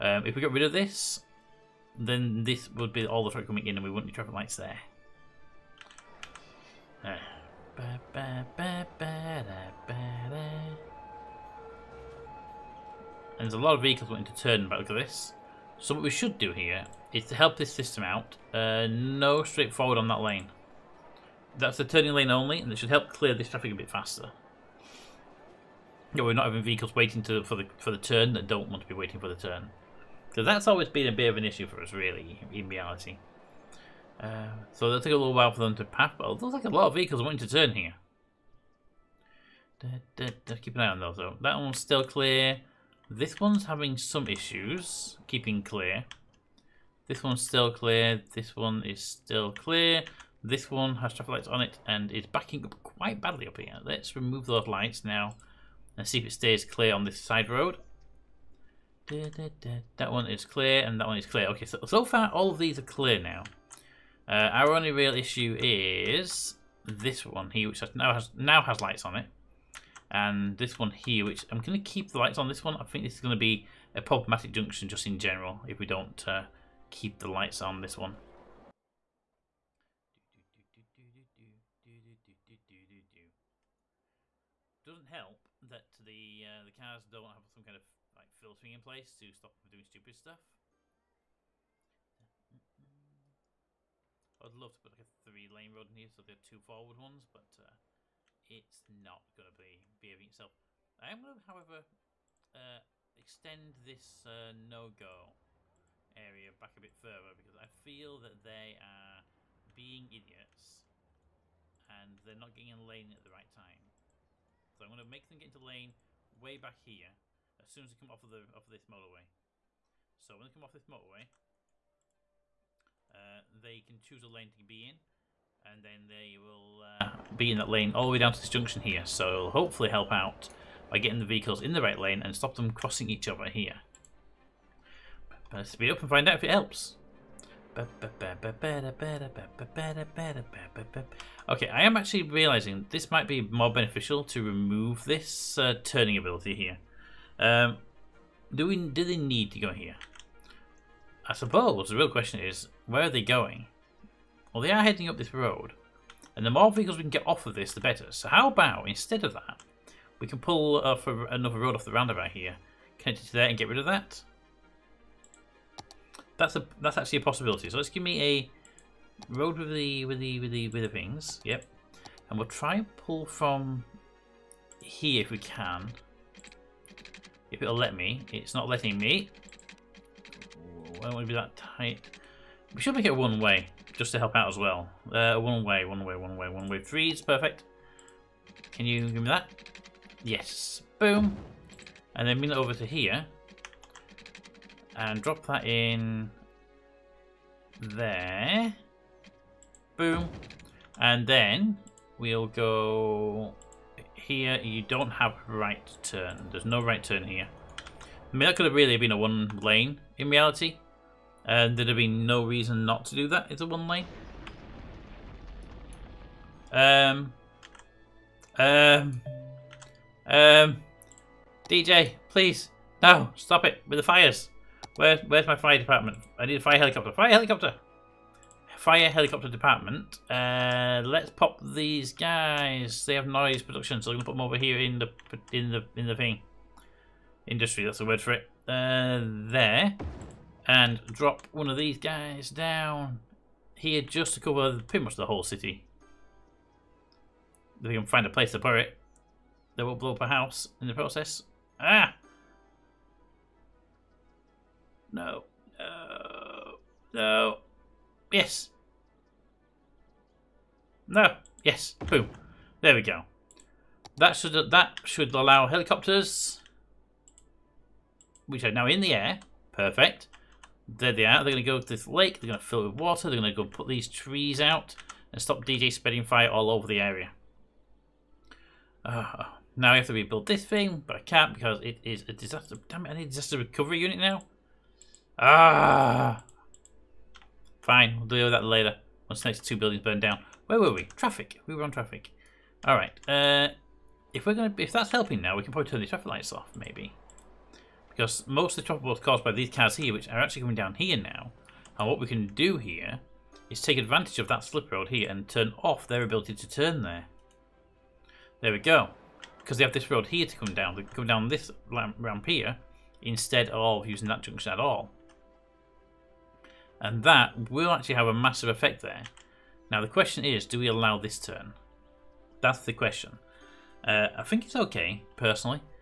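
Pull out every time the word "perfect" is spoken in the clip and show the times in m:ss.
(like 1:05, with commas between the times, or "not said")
3:07, 4:29.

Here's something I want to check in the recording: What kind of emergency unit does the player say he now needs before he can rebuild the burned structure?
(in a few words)
disaster recovery unit.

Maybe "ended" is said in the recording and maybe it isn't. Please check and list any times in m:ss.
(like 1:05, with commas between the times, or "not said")
not said.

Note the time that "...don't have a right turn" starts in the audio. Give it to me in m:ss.
3:24.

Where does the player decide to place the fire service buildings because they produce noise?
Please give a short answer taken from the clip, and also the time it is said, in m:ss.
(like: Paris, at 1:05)
Industry, at 3:57.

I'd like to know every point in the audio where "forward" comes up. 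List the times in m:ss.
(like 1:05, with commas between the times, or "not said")
0:19, 1:36.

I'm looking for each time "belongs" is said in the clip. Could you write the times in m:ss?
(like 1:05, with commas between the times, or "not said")
not said.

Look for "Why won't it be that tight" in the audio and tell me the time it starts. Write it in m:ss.
3:00.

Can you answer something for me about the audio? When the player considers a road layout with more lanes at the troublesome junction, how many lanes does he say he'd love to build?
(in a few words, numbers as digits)
3.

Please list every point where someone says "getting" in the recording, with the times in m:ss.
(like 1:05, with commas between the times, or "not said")
1:52, 2:10.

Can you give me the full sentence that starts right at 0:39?
Da, da, da, keep an eye on those, though.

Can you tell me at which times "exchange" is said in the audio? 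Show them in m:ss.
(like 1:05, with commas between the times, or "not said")
not said.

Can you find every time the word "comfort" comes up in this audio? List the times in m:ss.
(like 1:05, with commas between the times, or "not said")
not said.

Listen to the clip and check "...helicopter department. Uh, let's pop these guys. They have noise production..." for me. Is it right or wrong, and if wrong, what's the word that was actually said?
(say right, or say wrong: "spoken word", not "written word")
right.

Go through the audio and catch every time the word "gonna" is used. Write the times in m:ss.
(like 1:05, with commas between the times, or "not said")
3:54, 4:54.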